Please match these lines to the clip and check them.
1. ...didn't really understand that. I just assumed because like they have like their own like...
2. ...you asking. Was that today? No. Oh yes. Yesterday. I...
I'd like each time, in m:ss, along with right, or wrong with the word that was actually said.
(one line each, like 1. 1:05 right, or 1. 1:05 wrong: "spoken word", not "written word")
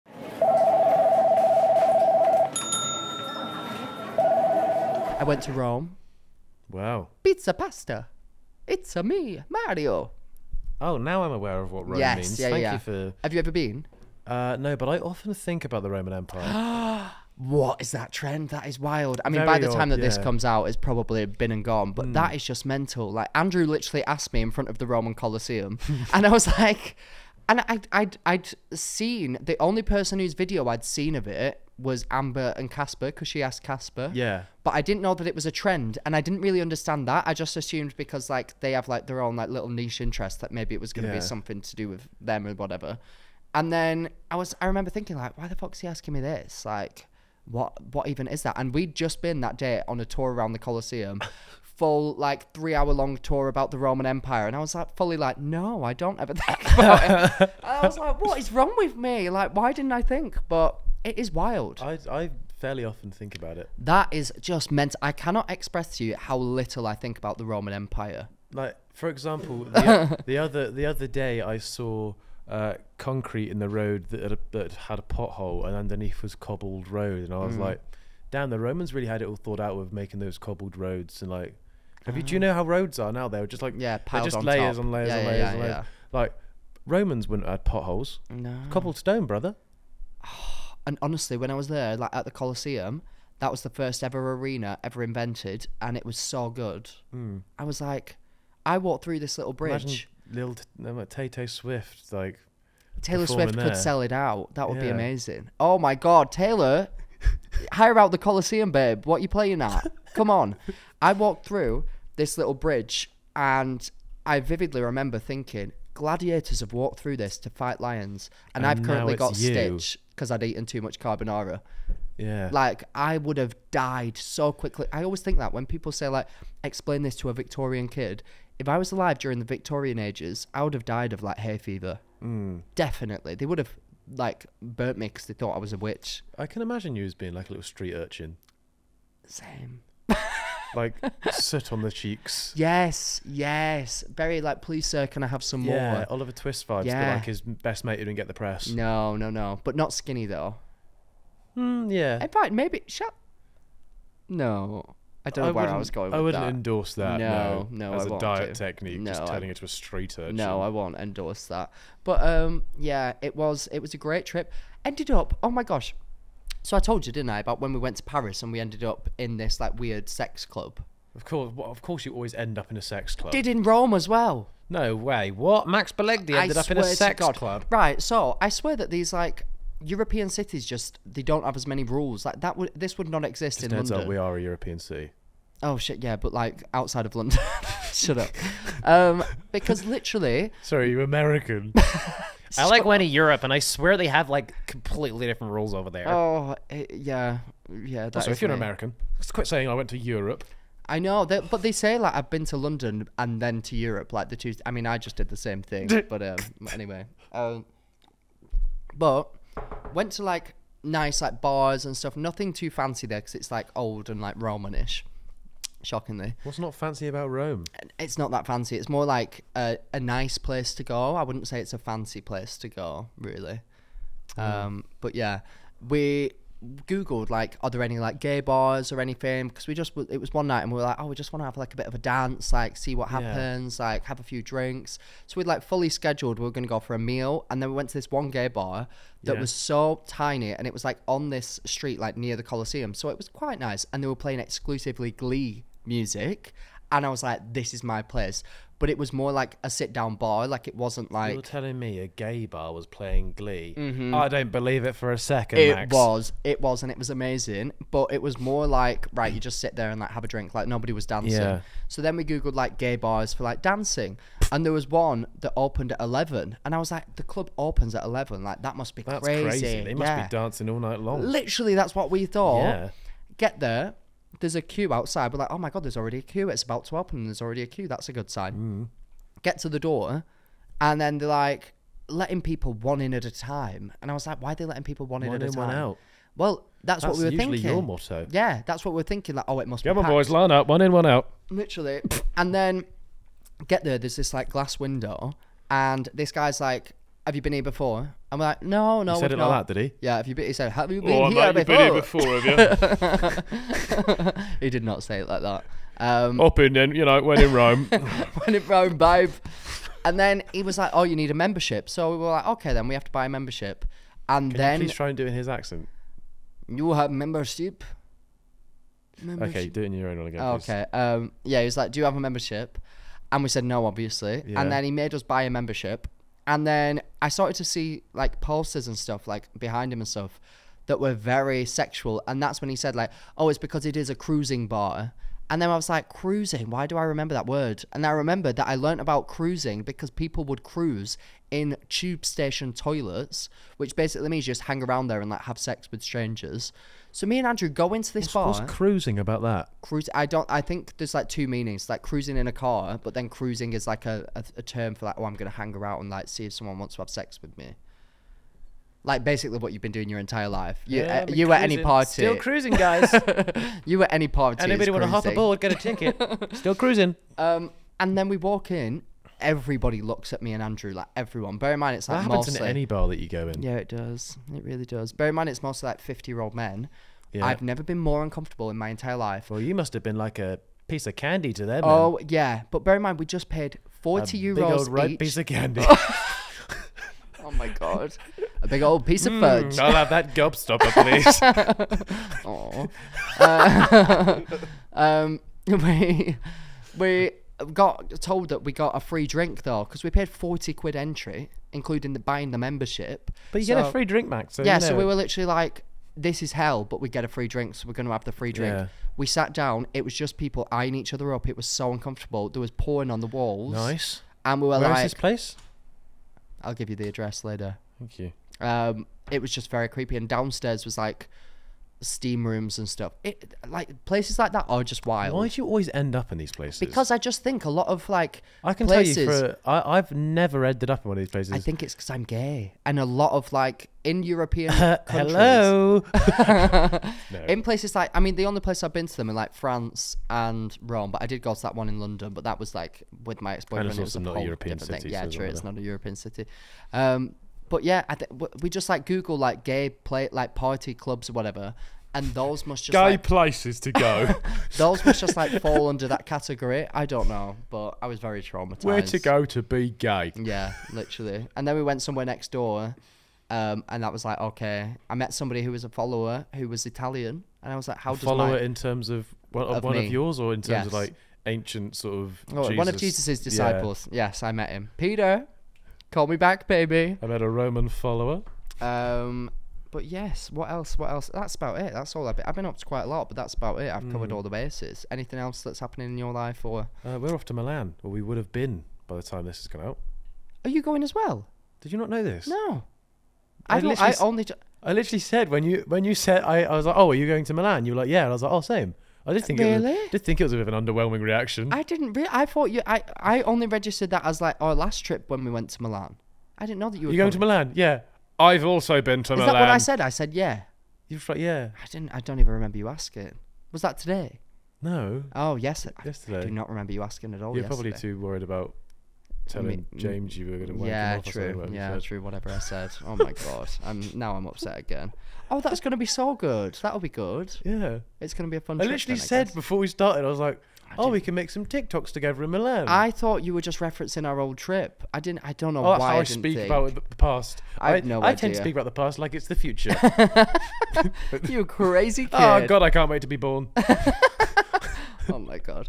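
1. 0:36 right
2. 8:32 right.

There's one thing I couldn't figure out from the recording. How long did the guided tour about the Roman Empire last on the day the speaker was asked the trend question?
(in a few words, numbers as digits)
3 hours.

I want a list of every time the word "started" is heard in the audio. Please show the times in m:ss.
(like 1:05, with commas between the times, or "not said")
5:27, 8:49.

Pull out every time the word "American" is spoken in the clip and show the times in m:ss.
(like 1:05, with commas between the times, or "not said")
3:11, 3:18.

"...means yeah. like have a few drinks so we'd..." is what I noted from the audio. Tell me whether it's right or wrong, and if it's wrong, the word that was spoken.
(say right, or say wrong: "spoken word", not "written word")
wrong: "happens", not "means".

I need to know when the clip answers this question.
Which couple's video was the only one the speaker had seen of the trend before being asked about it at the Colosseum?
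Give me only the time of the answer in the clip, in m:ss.
0:32.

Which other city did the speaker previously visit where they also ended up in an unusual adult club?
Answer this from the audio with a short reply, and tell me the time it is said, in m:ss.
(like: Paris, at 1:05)
Paris, at 2:48.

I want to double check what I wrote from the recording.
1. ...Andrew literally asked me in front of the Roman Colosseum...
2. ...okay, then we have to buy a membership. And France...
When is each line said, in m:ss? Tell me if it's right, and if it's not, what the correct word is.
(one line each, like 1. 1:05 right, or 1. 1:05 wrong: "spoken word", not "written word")
1. 0:23 right
2. 5:12 wrong: "Can", not "France".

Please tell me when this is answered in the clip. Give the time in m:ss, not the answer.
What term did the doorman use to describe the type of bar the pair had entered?
5:34.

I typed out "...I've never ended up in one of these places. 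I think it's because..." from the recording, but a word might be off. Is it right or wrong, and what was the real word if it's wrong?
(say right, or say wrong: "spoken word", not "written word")
right.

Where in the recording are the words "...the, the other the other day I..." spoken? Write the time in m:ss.
1:09.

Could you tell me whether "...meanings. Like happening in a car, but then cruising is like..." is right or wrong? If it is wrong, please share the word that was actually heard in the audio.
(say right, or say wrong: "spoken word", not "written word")
wrong: "cruising", not "happening".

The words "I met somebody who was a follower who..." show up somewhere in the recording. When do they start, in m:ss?
7:45.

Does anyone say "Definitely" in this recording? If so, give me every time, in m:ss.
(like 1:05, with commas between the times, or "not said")
2:12.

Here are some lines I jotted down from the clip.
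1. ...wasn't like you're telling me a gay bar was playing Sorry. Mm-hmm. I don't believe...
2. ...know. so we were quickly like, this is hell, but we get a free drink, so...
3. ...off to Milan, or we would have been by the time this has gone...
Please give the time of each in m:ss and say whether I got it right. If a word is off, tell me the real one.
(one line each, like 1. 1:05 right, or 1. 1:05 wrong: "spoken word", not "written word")
1. 4:10 wrong: "Glee", not "Sorry"
2. 6:44 wrong: "literally", not "quickly"
3. 8:07 right.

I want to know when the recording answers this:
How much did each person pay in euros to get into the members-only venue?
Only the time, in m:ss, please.
6:23.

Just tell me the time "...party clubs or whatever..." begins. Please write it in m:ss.
7:30.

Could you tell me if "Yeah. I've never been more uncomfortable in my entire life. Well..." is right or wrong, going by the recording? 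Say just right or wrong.
right.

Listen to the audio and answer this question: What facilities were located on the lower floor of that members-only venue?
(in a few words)
Steam rooms.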